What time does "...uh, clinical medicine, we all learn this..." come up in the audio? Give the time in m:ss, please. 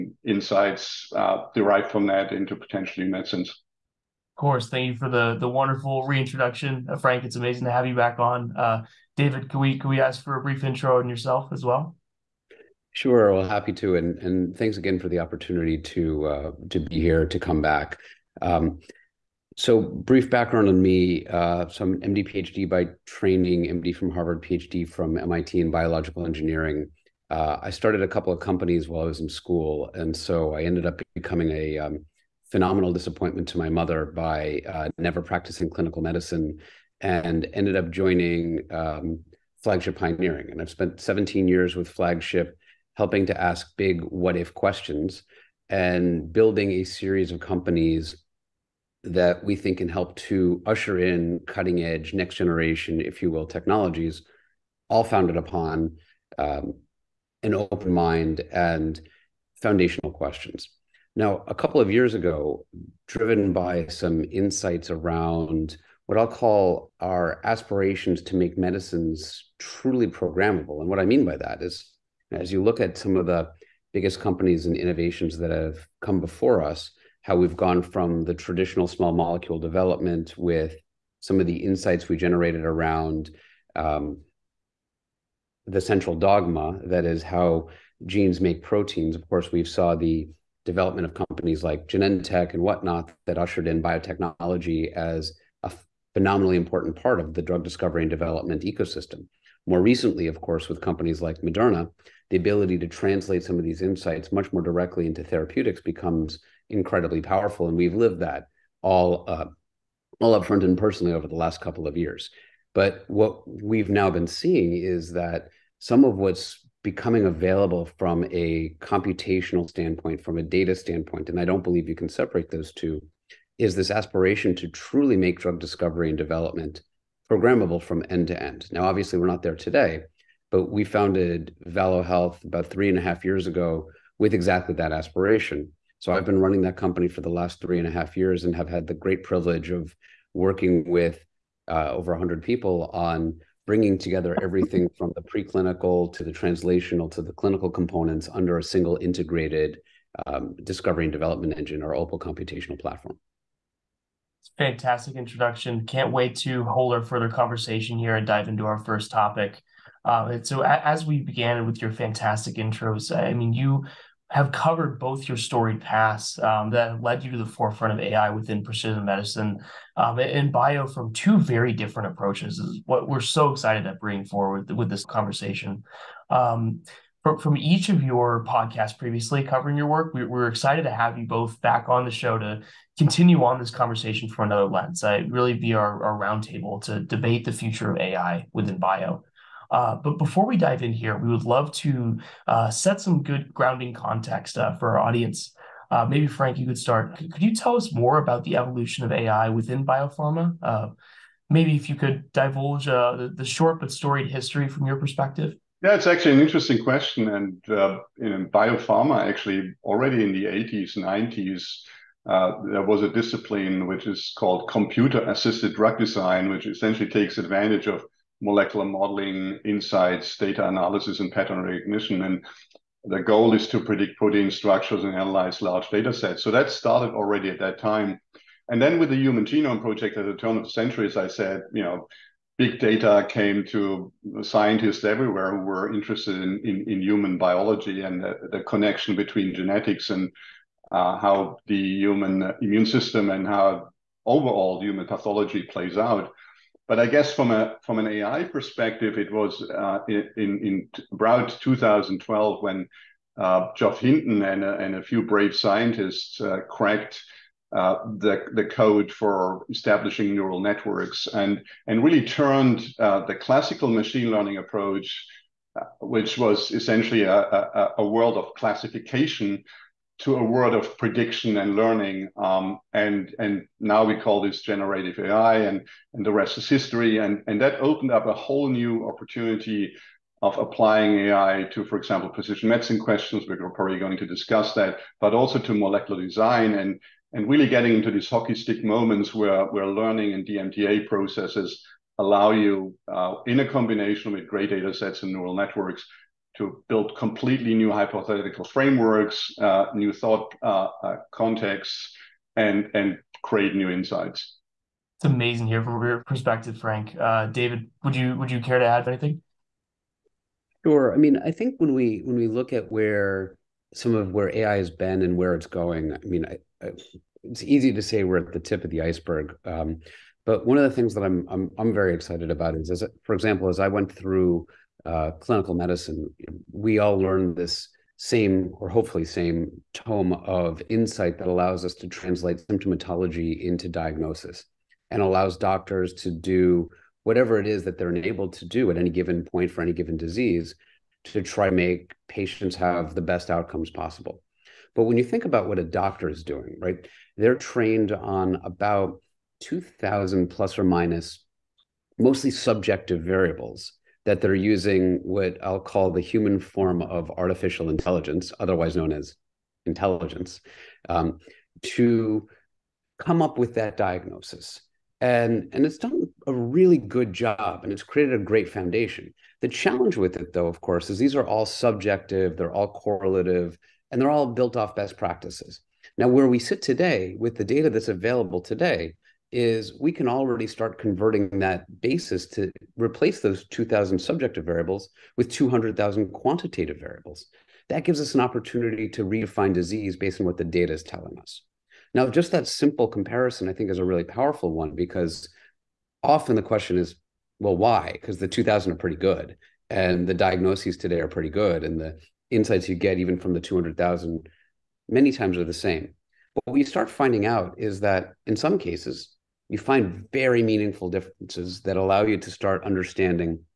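5:25.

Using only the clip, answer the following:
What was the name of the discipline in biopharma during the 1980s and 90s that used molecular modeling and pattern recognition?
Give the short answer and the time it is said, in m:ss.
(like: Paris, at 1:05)
computer assisted drug design, at 3:34.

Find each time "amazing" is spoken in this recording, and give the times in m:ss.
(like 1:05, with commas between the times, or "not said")
0:07, 5:05.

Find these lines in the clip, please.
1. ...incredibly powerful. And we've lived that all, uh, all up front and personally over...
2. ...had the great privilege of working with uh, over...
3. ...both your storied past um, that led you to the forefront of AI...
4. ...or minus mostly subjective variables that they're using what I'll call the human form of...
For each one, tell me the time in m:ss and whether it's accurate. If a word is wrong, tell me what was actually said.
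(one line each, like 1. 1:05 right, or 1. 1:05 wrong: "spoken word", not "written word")
1. 1:46 right
2. 2:18 right
3. 2:44 right
4. 5:50 right.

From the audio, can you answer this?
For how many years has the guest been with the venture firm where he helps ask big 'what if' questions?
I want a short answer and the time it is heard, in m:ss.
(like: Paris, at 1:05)
17, at 0:40.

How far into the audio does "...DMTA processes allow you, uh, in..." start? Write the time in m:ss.
4:50.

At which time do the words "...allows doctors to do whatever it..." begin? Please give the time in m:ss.
5:35.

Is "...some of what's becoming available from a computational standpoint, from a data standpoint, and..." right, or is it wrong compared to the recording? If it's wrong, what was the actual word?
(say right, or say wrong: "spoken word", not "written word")
right.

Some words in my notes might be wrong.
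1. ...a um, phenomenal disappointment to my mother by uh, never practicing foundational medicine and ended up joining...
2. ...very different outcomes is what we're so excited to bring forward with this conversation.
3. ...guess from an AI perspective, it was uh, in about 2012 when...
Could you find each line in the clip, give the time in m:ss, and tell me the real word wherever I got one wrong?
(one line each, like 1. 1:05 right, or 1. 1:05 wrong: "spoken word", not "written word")
1. 0:31 wrong: "clinical", not "foundational"
2. 2:51 wrong: "approaches", not "outcomes"
3. 4:07 right.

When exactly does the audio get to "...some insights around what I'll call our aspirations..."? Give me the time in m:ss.
1:03.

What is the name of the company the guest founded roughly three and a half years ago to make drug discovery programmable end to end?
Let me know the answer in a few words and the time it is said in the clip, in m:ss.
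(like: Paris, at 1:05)
Valo Health, at 2:11.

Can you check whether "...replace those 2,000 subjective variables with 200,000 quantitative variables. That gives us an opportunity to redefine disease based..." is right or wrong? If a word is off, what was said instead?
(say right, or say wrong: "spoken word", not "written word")
right.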